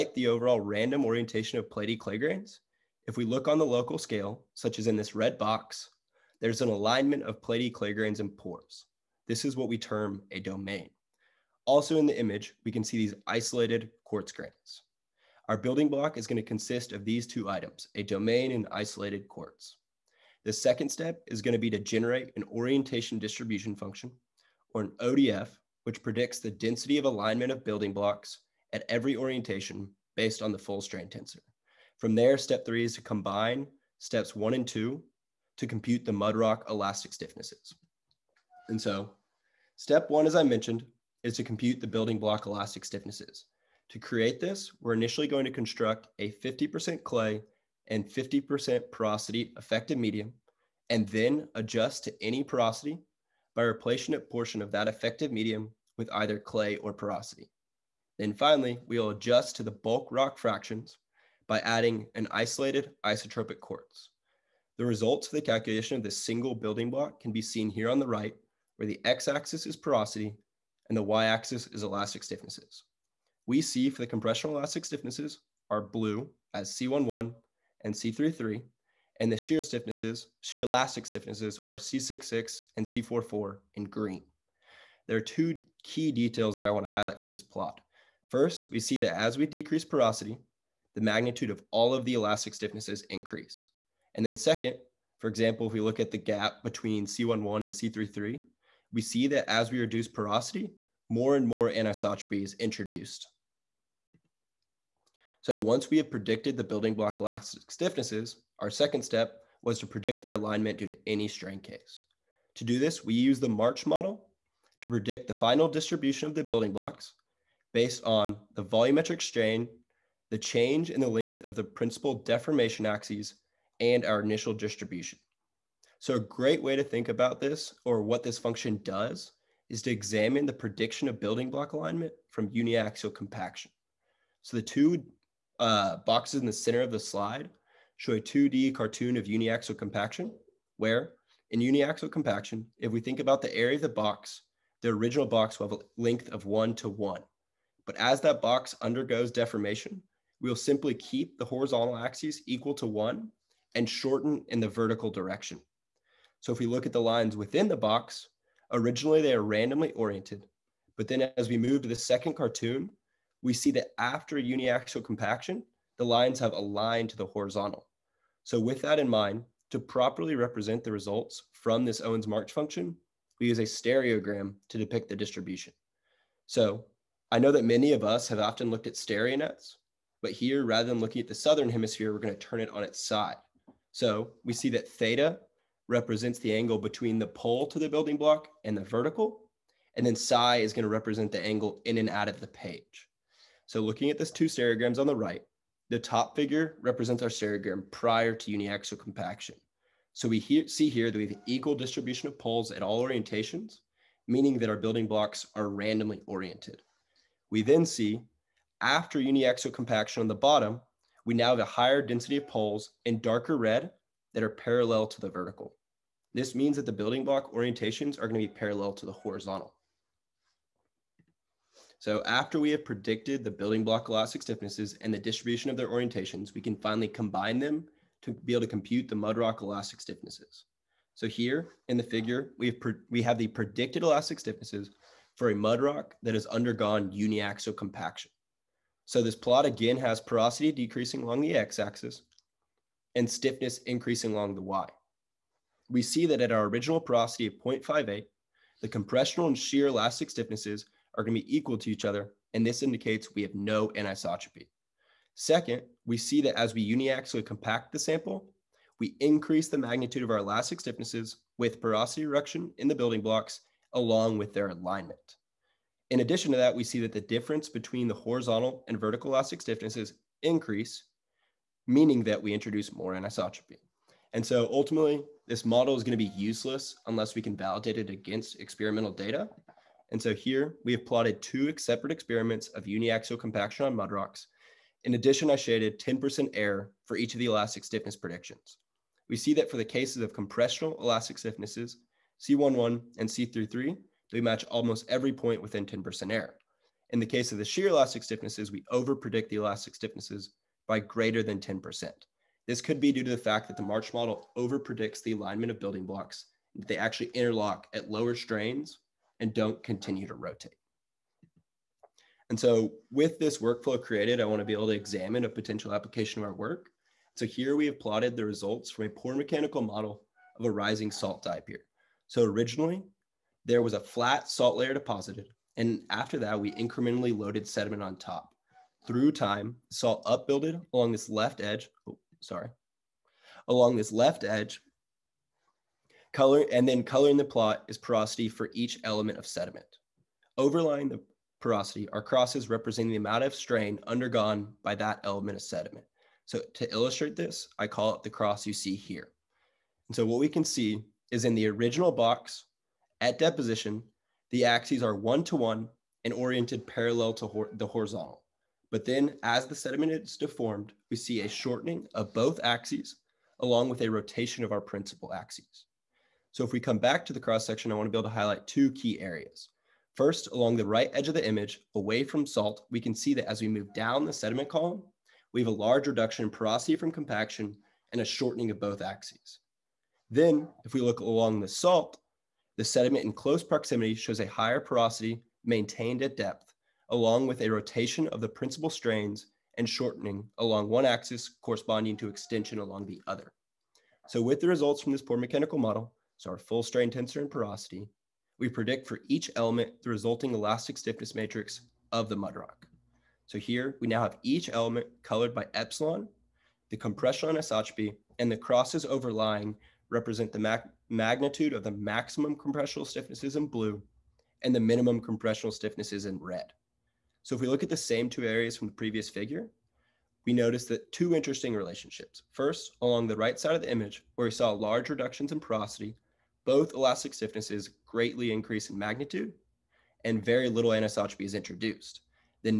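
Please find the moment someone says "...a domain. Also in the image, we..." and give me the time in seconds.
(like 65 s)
10 s.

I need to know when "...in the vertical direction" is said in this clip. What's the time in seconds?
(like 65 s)
154 s.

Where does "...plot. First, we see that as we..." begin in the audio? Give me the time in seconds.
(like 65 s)
87 s.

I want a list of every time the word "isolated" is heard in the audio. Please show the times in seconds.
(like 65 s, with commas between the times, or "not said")
13 s, 18 s, 62 s.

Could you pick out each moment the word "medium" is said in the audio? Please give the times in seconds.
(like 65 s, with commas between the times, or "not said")
49 s, 55 s.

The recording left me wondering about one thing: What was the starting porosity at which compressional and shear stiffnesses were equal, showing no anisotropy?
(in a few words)
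0.58.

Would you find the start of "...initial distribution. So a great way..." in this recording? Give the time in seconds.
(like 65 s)
124 s.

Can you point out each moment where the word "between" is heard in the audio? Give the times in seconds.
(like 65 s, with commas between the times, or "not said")
96 s, 186 s, 267 s.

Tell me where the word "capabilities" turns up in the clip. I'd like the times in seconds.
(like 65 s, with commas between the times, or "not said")
not said.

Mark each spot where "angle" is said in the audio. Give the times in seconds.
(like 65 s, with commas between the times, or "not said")
186 s, 191 s.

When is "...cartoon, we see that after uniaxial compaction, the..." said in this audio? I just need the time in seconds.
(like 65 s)
162 s.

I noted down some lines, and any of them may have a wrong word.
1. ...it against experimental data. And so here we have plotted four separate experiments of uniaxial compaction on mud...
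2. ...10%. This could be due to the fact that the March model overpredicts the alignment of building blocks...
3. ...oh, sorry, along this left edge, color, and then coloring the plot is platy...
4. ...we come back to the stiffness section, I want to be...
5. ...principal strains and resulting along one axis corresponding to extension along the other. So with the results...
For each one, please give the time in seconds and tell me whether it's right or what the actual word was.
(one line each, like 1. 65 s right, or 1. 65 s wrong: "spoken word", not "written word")
1. 277 s wrong: "two", not "four"
2. 301 s right
3. 332 s wrong: "porosity", not "platy"
4. 366 s wrong: "cross", not "stiffness"
5. 388 s wrong: "shortening", not "resulting".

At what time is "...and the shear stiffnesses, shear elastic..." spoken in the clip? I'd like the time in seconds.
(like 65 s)
79 s.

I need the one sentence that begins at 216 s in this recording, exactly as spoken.
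This means that the building block orientations are gonna be parallel to the horizontal.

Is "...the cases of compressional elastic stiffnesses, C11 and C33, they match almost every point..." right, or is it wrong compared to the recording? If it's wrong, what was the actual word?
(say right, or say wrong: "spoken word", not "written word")
right.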